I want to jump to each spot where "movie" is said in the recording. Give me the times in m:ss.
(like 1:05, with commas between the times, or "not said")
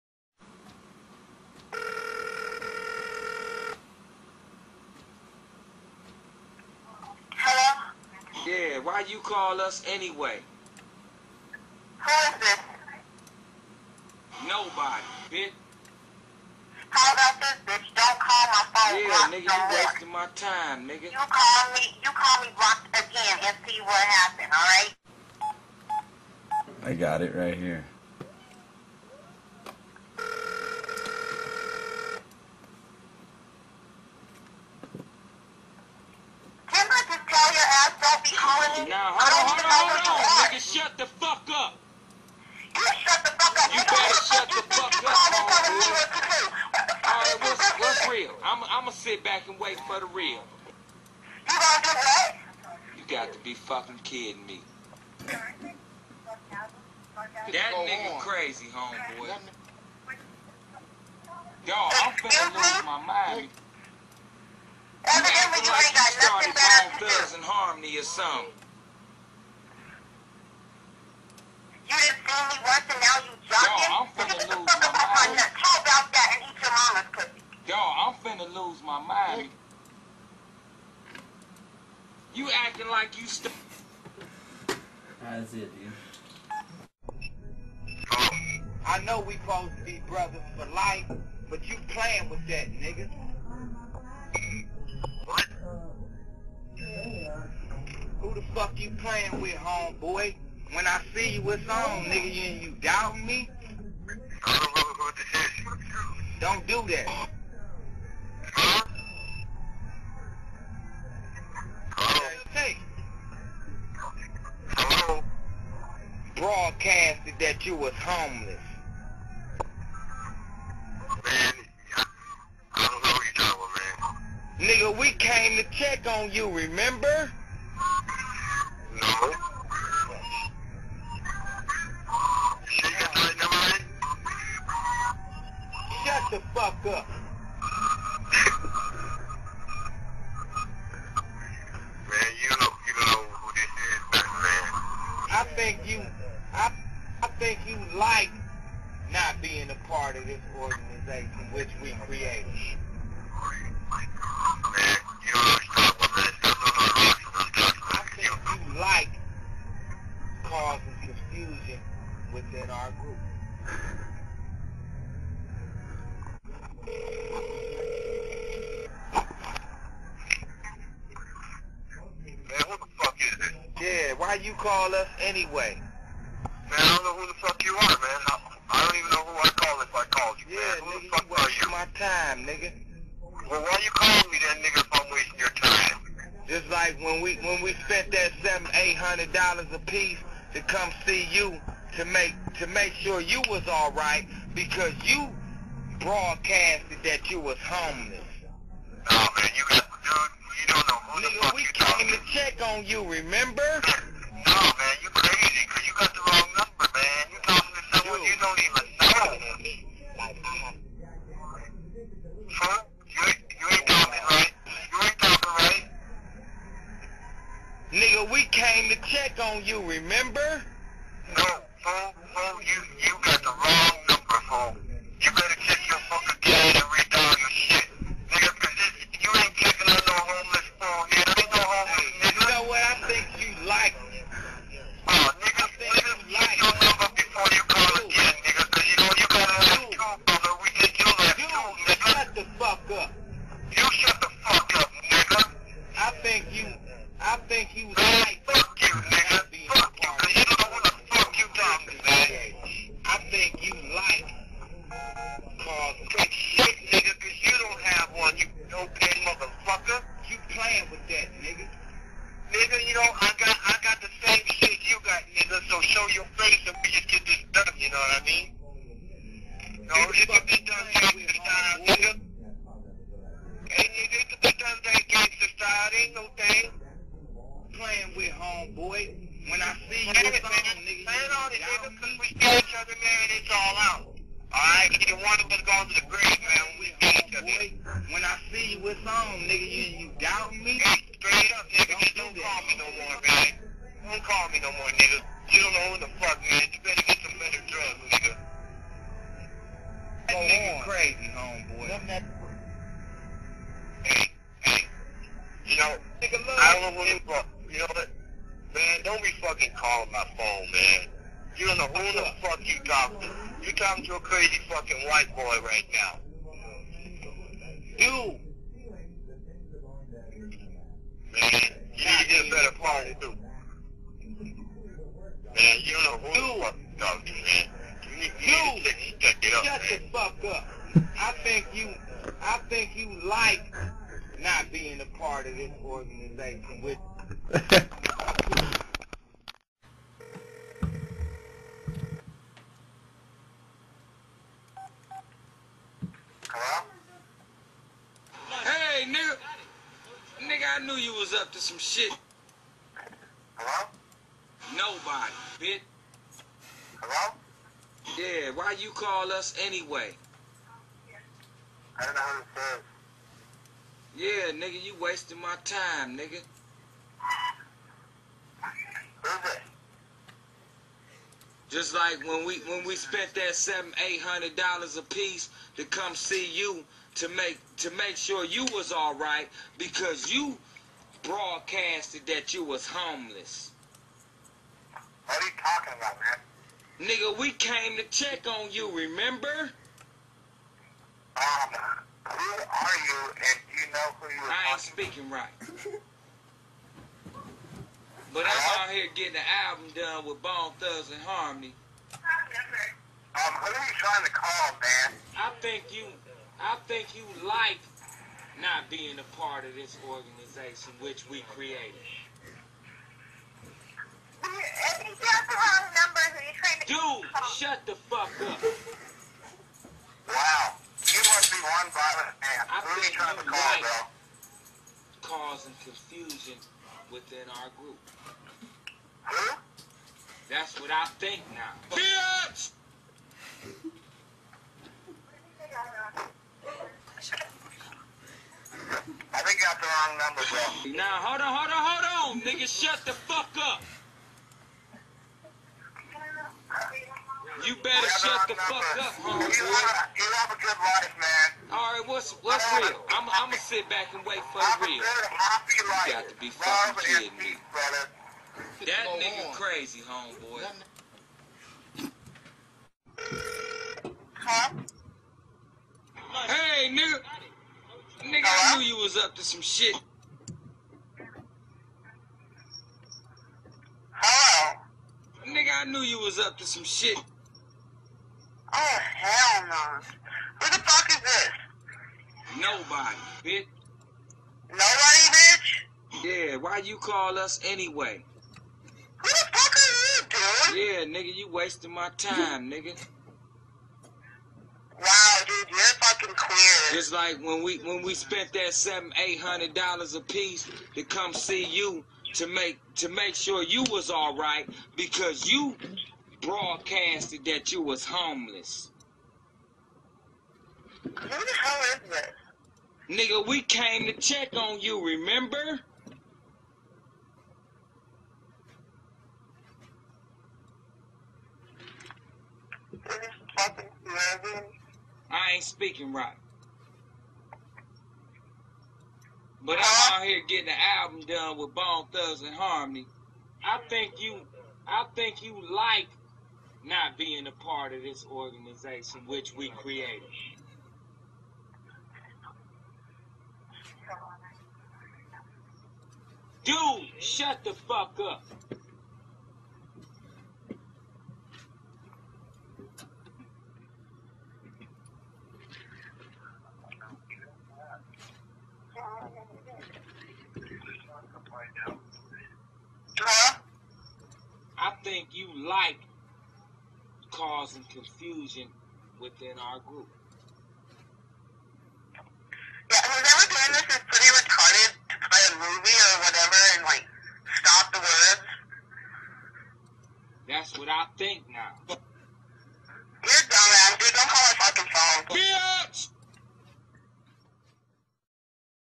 9:35.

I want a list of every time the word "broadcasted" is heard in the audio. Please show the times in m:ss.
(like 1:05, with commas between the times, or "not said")
1:56, 3:15, 6:21, 8:26.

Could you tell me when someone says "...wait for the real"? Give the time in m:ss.
0:49.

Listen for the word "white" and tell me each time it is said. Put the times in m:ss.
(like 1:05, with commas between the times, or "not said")
5:15.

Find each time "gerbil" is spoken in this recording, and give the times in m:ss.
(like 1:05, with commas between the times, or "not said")
not said.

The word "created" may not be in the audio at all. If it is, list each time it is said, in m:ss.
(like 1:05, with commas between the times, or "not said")
2:32, 6:51, 8:59.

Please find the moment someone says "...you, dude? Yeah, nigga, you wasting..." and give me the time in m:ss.
8:10.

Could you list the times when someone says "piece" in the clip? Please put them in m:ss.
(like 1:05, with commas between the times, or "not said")
3:09, 6:15, 8:20.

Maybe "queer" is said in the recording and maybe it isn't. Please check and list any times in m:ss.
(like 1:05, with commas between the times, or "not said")
8:16.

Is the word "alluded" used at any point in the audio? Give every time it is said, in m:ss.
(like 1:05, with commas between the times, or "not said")
not said.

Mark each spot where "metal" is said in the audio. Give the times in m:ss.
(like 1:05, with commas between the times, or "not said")
not said.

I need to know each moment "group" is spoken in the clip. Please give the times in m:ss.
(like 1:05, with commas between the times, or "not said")
2:43, 7:07, 9:29.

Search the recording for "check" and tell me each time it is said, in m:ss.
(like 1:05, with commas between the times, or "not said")
2:05, 3:22, 6:28, 8:34.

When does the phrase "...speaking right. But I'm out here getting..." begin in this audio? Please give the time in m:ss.
8:45.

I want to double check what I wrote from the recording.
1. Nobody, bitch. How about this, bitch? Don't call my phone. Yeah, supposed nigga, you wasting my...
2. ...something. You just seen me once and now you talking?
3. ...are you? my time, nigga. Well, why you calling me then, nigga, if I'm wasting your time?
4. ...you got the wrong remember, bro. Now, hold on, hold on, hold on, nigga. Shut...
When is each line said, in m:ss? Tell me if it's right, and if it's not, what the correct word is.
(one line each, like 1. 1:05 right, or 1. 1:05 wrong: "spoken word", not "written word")
1. 0:14 wrong: "blocked", not "supposed"
2. 1:08 wrong: "jocking", not "talking"
3. 3:01 right
4. 7:19 wrong: "number", not "remember".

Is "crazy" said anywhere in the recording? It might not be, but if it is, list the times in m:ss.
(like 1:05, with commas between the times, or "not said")
0:58, 5:00, 5:14, 7:39.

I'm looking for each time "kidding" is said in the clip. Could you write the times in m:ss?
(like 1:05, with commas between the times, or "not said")
0:54, 7:37.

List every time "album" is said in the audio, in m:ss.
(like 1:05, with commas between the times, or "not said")
6:39, 8:50.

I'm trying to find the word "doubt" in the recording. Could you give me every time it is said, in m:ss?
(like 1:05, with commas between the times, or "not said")
1:42, 4:50.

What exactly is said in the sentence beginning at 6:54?
If you the wrong numbers and you trying to Dude, shut the fuck up.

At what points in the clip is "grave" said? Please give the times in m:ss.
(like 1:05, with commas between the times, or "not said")
4:46.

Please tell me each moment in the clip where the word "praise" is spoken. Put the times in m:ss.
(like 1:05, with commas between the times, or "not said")
not said.